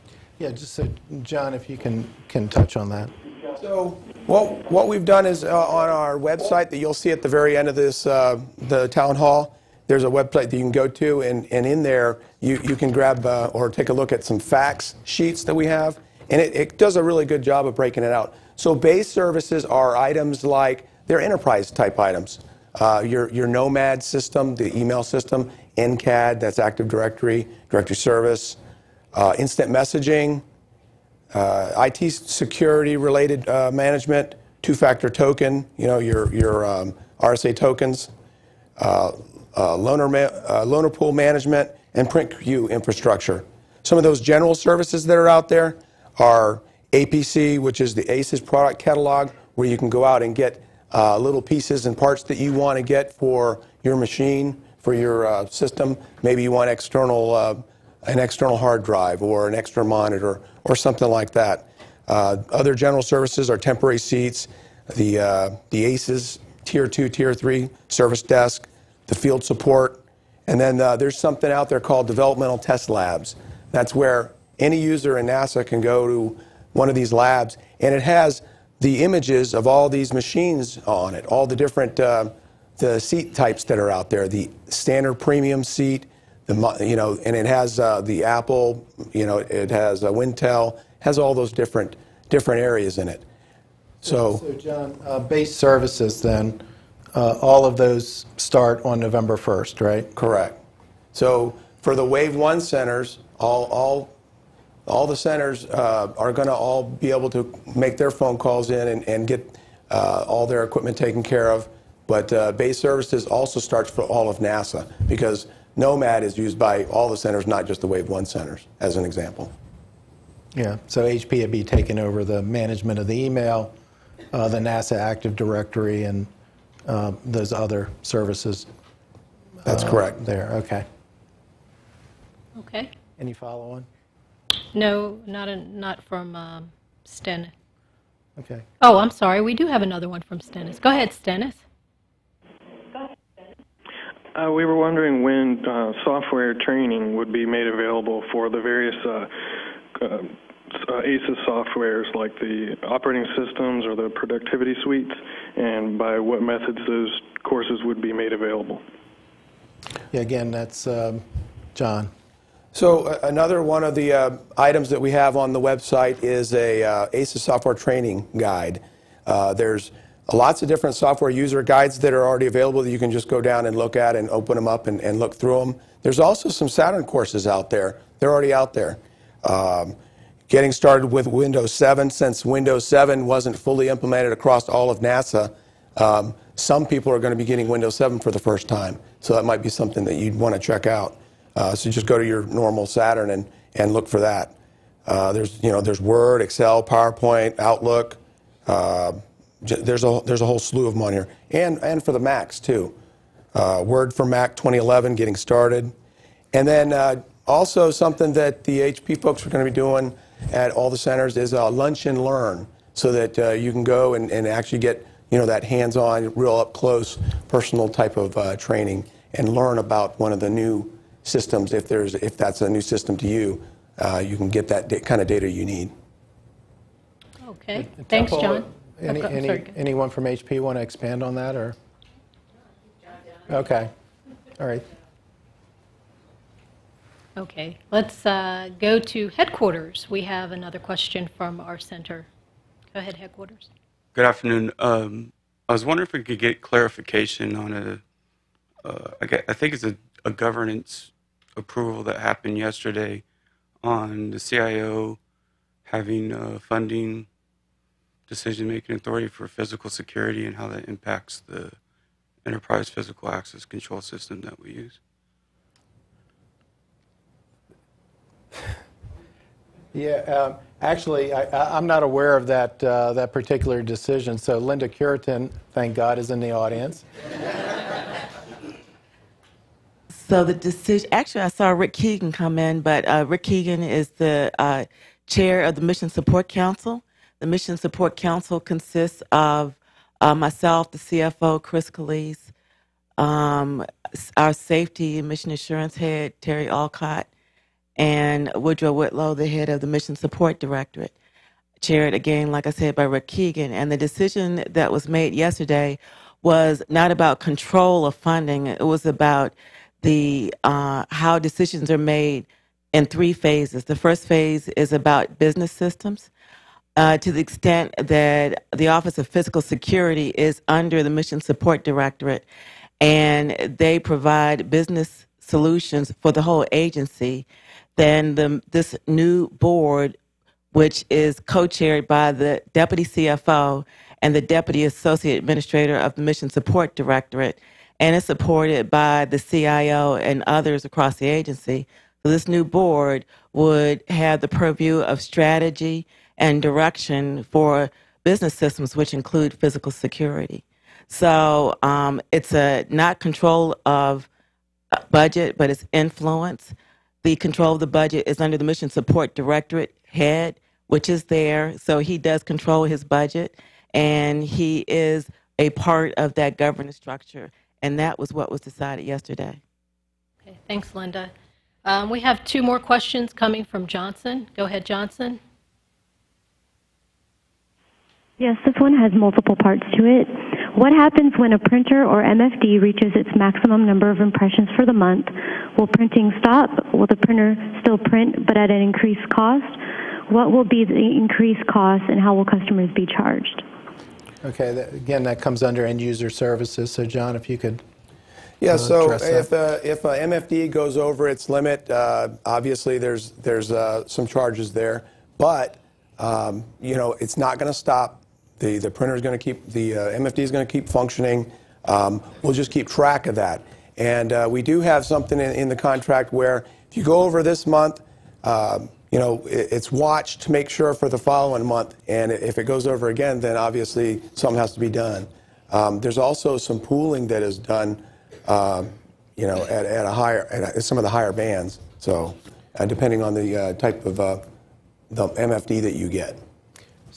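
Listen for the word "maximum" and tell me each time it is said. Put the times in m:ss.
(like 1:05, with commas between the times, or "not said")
6:23.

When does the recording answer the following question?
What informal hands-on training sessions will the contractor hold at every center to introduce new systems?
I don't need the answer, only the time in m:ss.
3:31.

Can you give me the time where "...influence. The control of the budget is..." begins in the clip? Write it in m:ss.
5:55.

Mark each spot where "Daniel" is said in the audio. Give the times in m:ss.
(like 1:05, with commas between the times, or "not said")
not said.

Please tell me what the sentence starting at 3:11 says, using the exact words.
Uh, so just go to your normal SATERN and, and look for that.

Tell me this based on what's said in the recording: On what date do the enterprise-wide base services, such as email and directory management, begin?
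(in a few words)
November 1st.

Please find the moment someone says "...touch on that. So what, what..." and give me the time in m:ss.
0:02.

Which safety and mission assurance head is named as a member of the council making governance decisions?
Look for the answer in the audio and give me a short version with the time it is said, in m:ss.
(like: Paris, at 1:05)
Terry Wilcutt, at 4:56.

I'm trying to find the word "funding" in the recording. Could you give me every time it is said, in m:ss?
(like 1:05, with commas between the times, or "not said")
4:16, 5:08.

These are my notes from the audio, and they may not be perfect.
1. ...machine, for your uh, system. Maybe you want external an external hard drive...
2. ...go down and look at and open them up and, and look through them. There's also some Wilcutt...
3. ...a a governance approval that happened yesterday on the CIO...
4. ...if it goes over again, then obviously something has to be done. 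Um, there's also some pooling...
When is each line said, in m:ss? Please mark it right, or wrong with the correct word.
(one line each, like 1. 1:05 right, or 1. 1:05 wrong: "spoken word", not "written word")
1. 0:53 right
2. 2:53 wrong: "SATERN", not "Wilcutt"
3. 4:09 right
4. 7:02 right.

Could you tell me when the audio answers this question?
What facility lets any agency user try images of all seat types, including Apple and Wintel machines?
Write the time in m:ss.
1:12.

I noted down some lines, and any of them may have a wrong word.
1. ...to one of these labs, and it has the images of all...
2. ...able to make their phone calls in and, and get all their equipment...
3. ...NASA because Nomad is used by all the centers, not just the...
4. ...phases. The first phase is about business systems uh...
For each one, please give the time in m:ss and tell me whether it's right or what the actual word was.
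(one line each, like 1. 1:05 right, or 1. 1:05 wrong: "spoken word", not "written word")
1. 1:16 right
2. 1:47 right
3. 1:54 right
4. 5:13 right.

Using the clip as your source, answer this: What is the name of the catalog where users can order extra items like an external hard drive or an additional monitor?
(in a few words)
ACES product catalog.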